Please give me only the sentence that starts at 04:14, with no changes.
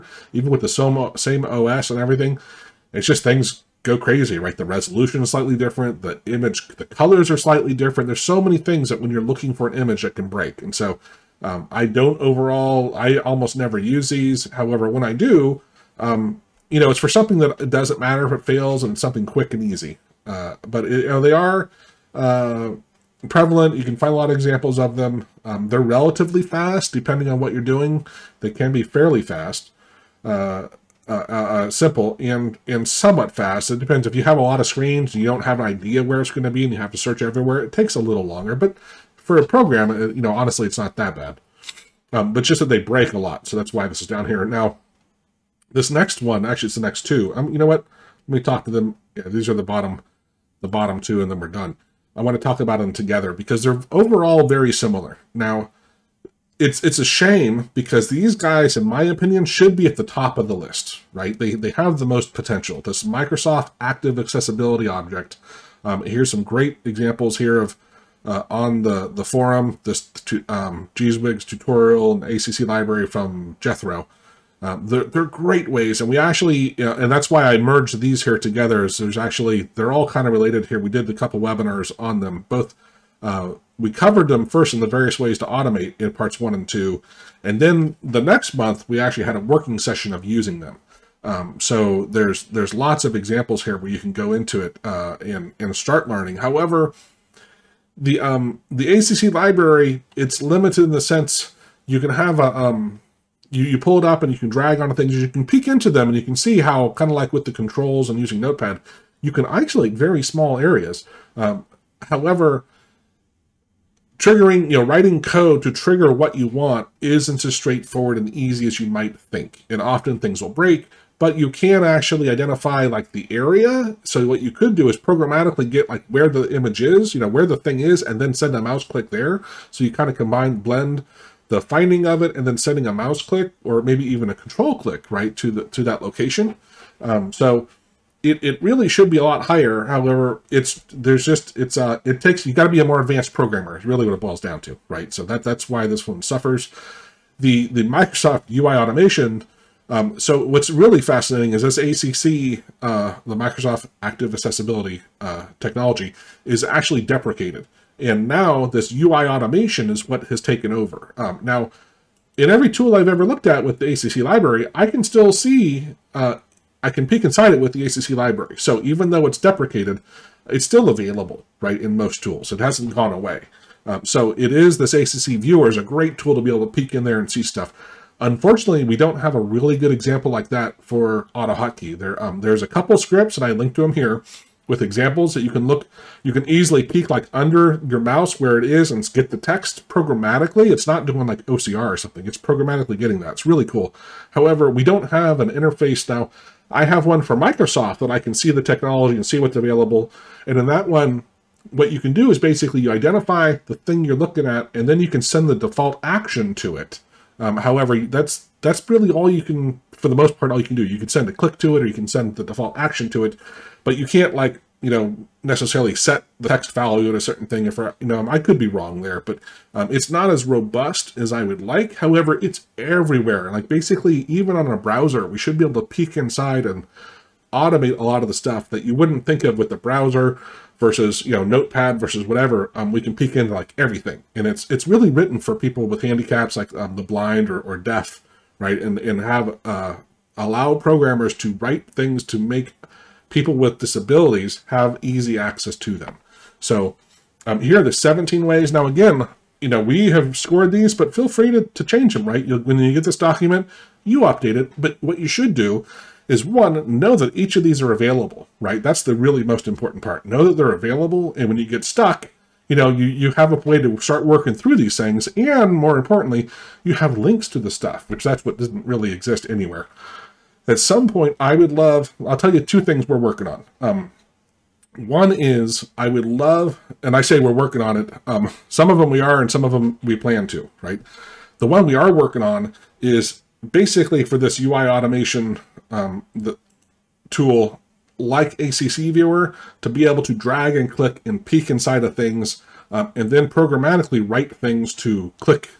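But what you should do is one, know that each of these are available, right?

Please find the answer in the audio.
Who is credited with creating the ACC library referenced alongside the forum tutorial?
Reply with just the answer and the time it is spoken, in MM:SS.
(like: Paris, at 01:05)
Jethrow, at 01:13.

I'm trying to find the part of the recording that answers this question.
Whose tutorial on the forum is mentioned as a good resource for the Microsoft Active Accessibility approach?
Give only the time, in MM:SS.
01:10.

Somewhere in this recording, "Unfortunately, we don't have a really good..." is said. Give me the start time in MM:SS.
02:58.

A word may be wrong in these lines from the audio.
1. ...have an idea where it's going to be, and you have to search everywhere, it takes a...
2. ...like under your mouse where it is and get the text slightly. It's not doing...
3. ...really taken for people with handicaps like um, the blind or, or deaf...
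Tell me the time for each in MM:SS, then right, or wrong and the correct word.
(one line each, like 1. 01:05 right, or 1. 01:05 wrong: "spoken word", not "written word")
1. 00:35 right
2. 03:07 wrong: "programmatically", not "slightly"
3. 03:54 wrong: "written", not "taken".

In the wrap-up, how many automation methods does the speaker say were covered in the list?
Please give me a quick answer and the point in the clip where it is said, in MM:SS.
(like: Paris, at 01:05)
17, at 04:07.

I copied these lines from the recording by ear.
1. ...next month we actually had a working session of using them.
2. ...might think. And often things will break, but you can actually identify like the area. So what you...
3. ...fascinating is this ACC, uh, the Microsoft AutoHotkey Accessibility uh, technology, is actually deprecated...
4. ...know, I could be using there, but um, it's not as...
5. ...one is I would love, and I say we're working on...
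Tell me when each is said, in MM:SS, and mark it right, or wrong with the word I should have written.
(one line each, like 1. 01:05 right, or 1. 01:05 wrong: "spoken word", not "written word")
1. 01:28 right
2. 01:58 right
3. 02:31 wrong: "Active", not "AutoHotkey"
4. 03:38 wrong: "wrong", not "using"
5. 04:34 right.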